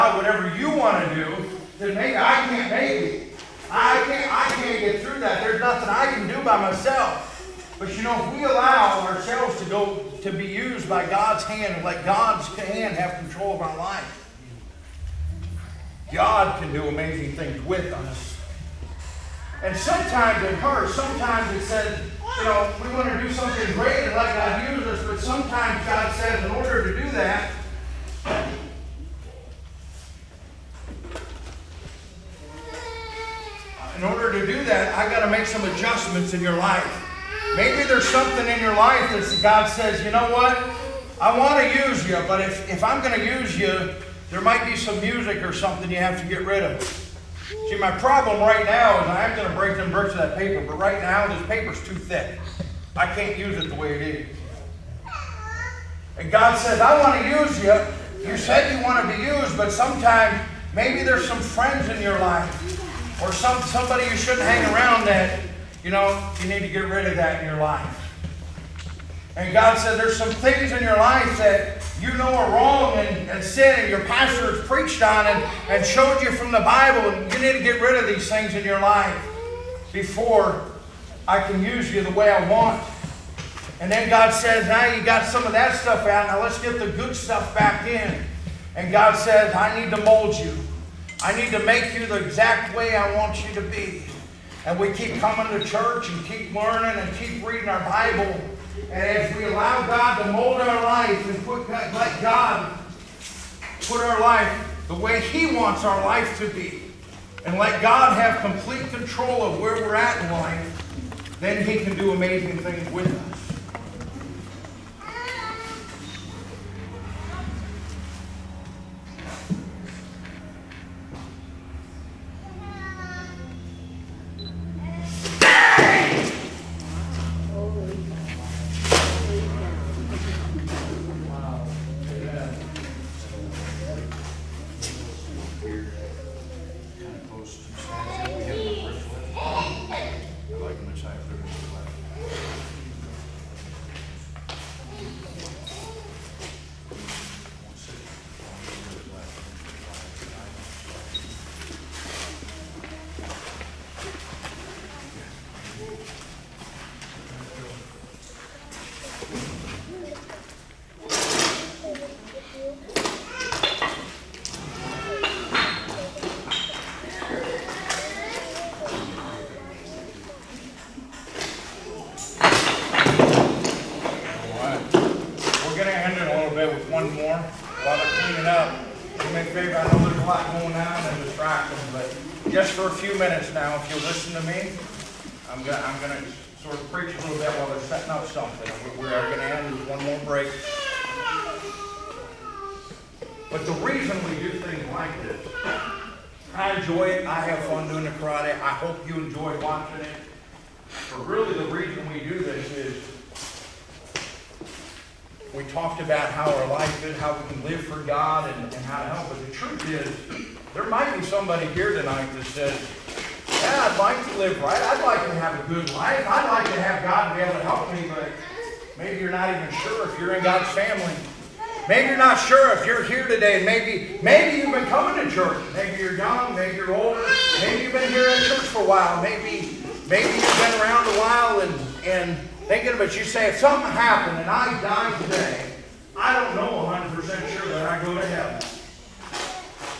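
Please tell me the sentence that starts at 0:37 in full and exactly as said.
Maybe there's something in your life that God says, you know what?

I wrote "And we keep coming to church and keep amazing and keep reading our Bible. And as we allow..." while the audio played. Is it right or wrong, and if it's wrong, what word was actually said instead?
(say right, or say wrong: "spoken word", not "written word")
wrong: "learning", not "amazing".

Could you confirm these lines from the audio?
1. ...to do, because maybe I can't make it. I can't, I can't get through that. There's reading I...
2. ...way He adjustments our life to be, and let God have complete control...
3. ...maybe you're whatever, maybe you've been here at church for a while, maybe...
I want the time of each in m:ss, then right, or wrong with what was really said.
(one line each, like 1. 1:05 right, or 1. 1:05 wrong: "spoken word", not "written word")
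1. 0:01 wrong: "nothing", not "reading"
2. 1:44 wrong: "wants", not "adjustments"
3. 3:46 wrong: "older", not "whatever".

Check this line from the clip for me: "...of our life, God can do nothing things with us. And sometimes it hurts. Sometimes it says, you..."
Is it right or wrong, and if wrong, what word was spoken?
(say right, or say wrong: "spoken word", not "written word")
wrong: "amazing", not "nothing".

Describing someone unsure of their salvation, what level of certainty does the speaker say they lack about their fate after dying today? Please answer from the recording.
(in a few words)
100 percent.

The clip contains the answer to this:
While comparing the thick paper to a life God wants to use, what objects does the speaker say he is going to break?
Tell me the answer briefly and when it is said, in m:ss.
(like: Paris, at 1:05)
bricks, at 0:49.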